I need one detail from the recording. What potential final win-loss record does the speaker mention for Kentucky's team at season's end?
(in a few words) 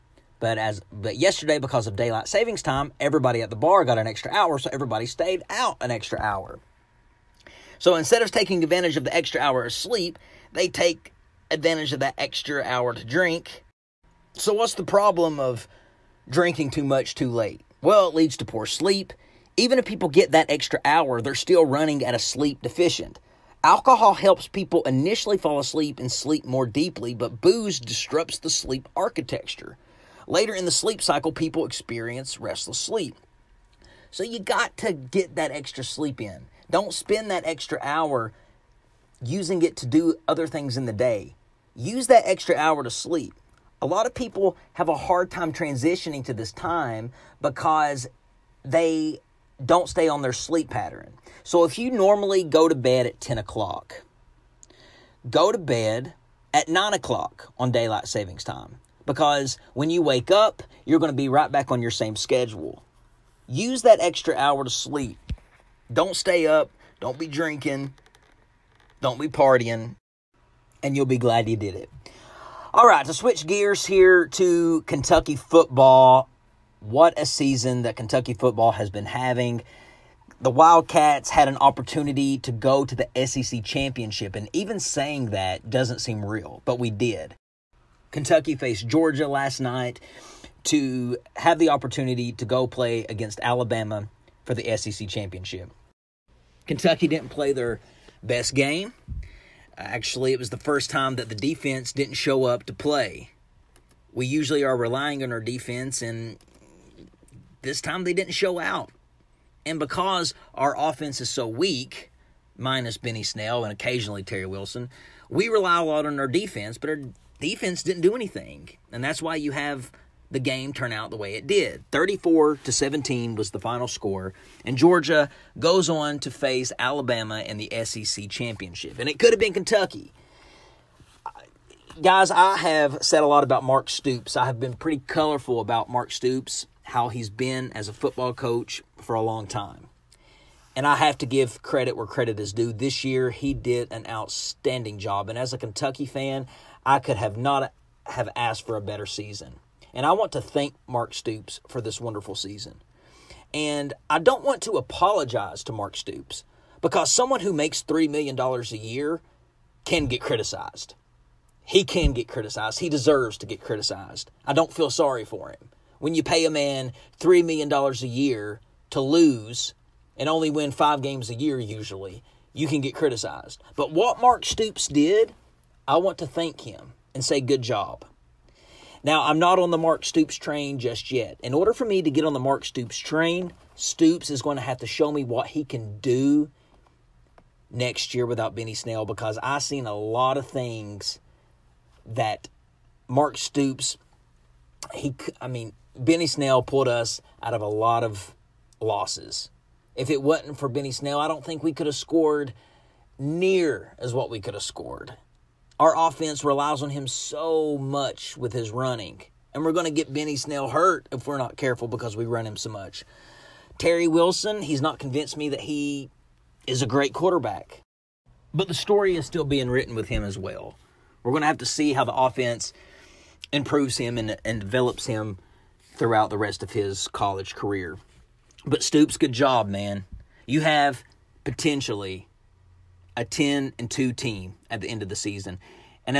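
10 and 2.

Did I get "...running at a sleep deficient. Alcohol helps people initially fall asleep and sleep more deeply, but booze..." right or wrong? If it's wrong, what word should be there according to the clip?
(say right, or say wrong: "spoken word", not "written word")
right.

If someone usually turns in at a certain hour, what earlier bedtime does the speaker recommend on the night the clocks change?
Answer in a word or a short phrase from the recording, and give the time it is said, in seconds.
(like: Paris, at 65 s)
9 o'clock, at 56 s.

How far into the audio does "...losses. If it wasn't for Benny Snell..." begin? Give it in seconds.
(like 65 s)
198 s.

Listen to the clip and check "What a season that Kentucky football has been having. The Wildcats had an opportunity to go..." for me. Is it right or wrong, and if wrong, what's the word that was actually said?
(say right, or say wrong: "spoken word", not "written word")
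right.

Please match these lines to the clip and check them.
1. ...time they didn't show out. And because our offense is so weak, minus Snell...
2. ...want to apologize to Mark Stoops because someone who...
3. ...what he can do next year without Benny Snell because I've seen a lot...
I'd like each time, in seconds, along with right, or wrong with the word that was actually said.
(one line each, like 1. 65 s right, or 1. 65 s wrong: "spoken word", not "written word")
1. 107 s wrong: "Benny", not "Snell"
2. 154 s right
3. 185 s right.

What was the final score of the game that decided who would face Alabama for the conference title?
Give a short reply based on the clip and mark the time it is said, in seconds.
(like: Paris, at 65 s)
34 to 17, at 121 s.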